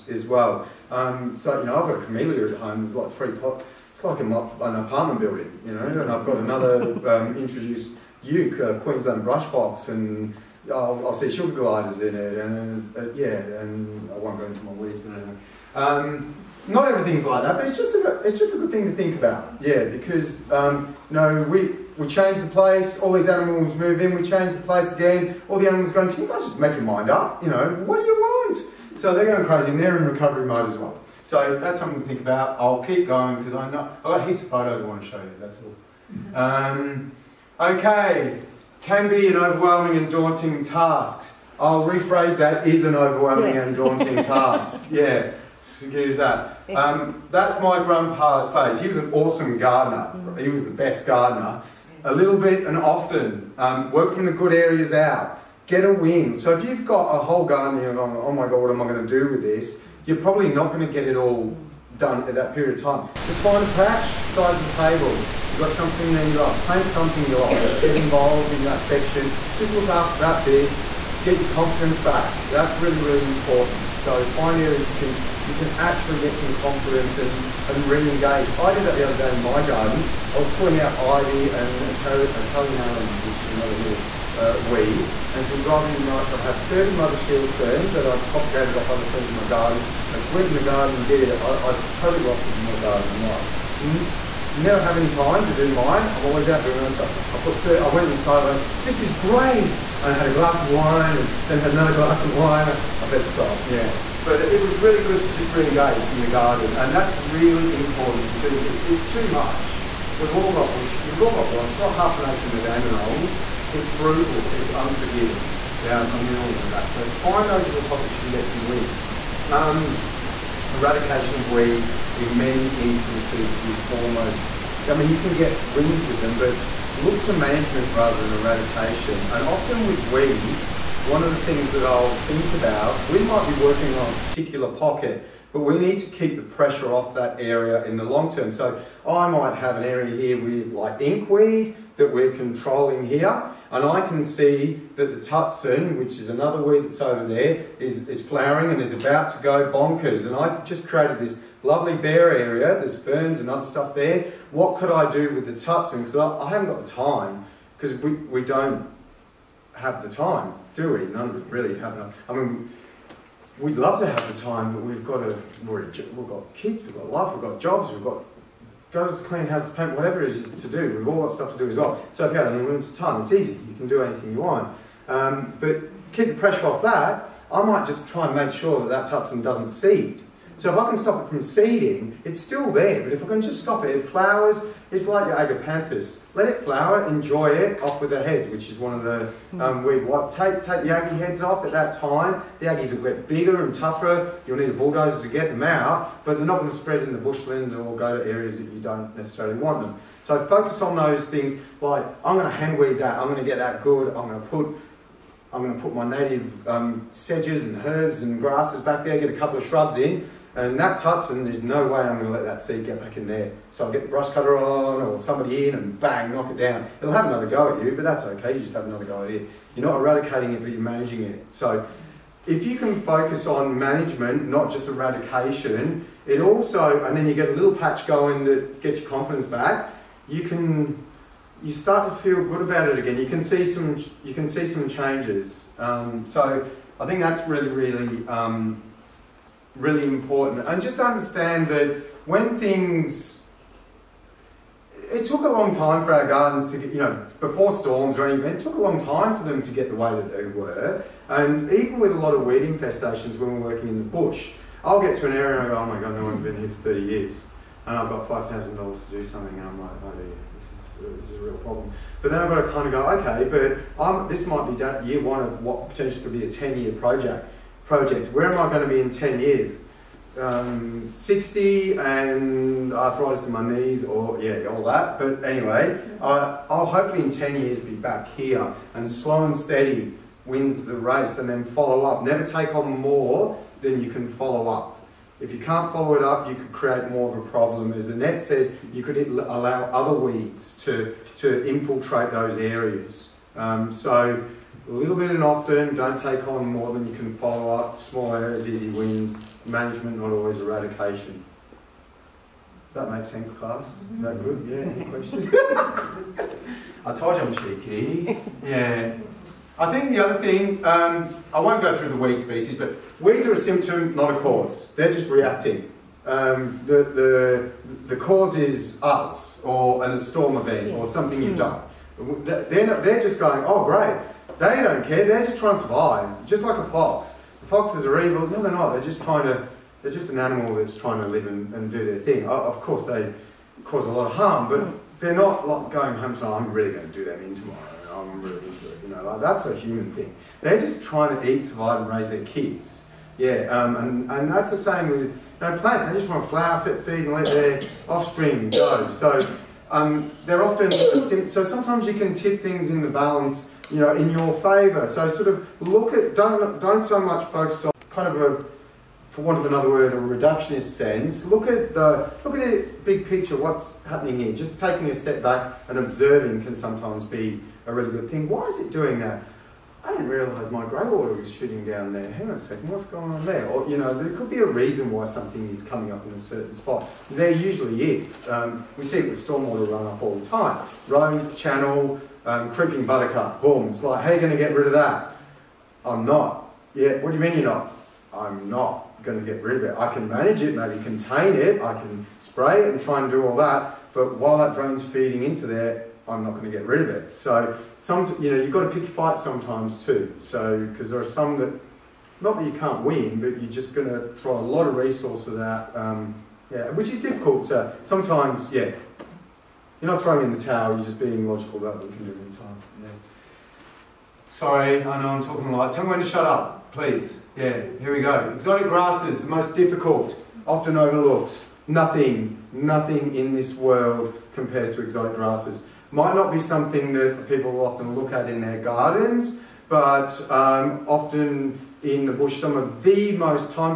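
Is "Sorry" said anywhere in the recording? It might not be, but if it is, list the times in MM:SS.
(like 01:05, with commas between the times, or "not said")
06:54.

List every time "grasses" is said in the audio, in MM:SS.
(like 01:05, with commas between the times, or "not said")
03:28, 06:58, 07:05.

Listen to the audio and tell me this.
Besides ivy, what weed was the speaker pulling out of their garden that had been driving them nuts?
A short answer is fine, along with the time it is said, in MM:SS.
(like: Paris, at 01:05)
Italian arums, at 01:21.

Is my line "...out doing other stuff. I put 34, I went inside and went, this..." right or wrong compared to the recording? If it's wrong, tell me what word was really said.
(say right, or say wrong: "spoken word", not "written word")
wrong: "30", not "34".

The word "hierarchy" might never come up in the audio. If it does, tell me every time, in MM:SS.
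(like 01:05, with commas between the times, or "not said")
not said.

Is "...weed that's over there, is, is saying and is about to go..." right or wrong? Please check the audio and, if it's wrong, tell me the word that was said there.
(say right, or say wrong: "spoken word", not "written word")
wrong: "flowering", not "saying".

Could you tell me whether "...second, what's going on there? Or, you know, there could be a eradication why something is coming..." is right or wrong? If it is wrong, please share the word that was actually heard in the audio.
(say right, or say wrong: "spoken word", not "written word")
wrong: "reason", not "eradication".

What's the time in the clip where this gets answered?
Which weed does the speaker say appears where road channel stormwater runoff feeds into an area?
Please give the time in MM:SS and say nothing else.
06:22.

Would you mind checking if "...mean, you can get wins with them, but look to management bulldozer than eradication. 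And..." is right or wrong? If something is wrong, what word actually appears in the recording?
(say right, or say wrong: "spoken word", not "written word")
wrong: "rather", not "bulldozer".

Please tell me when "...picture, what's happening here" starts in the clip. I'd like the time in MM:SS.
06:03.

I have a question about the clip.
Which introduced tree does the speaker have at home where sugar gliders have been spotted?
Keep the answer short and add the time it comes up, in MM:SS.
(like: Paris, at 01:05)
Queensland brush box, at 00:08.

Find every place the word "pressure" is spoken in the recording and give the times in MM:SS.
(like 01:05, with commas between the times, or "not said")
02:16, 02:56.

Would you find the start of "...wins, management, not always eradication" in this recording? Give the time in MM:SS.
04:58.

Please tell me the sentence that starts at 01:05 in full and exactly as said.
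You've got something there you love.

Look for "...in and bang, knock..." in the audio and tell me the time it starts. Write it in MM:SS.
03:35.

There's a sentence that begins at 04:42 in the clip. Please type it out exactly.
Never take on more than you can follow up.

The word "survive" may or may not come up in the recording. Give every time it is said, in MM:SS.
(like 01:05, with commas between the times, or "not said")
05:25, 05:41.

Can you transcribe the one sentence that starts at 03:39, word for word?
You're not eradicating it, but you're managing it.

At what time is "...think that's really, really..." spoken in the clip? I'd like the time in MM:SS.
03:57.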